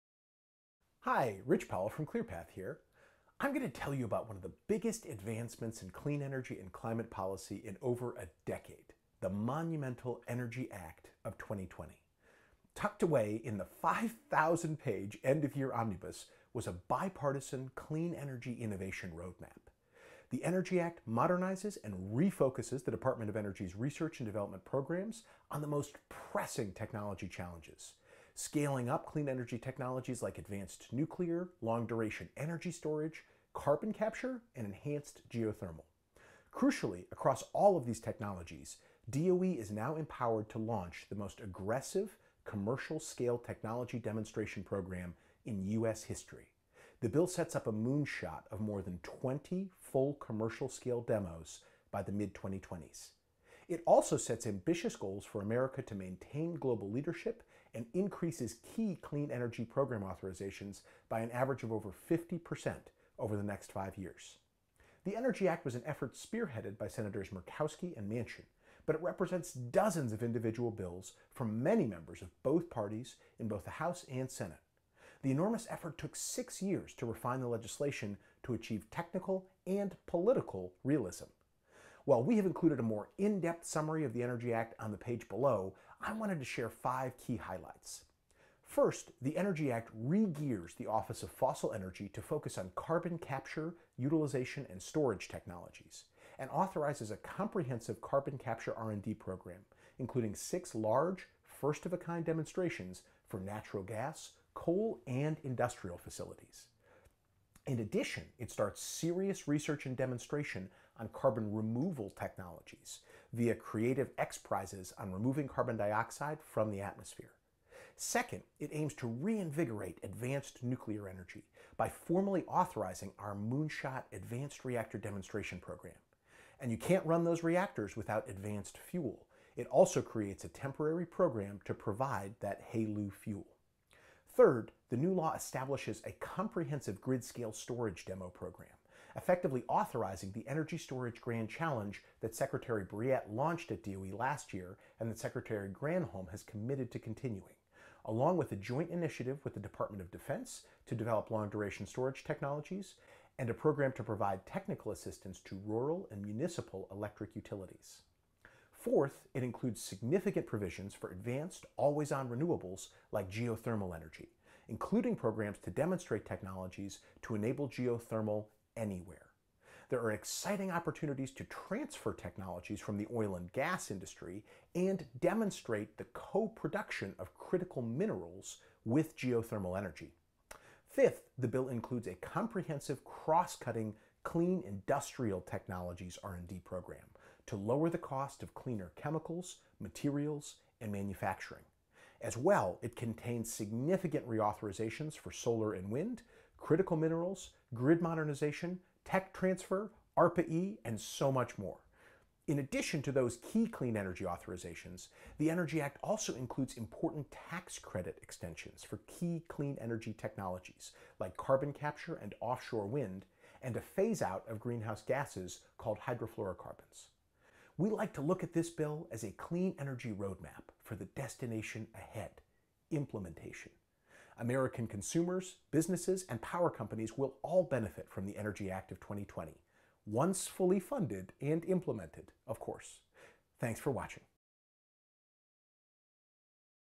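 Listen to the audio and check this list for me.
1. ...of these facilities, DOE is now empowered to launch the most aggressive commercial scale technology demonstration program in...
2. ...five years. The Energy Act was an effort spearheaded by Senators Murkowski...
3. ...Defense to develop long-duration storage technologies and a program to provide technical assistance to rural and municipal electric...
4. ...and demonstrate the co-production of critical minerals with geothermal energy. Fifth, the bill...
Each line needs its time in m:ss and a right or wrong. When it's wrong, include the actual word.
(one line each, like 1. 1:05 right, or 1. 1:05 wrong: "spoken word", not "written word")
1. 0:37 wrong: "technologies", not "facilities"
2. 1:03 right
3. 2:30 right
4. 2:54 right.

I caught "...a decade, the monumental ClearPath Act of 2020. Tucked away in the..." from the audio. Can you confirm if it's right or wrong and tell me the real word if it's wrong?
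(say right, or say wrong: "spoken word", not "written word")
wrong: "Energy", not "ClearPath".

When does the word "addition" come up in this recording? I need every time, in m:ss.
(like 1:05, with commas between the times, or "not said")
1:47, 3:22.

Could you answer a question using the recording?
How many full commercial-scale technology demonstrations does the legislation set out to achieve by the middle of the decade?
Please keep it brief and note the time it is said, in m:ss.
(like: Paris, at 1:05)
more than 20, at 0:48.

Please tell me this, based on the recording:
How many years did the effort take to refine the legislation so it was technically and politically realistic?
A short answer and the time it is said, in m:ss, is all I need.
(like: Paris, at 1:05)
6, at 1:16.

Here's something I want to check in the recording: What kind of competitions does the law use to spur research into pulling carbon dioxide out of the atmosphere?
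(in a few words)
X prizes.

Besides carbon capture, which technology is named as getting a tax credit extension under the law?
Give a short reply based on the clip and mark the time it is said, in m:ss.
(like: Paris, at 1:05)
offshore wind, at 3:32.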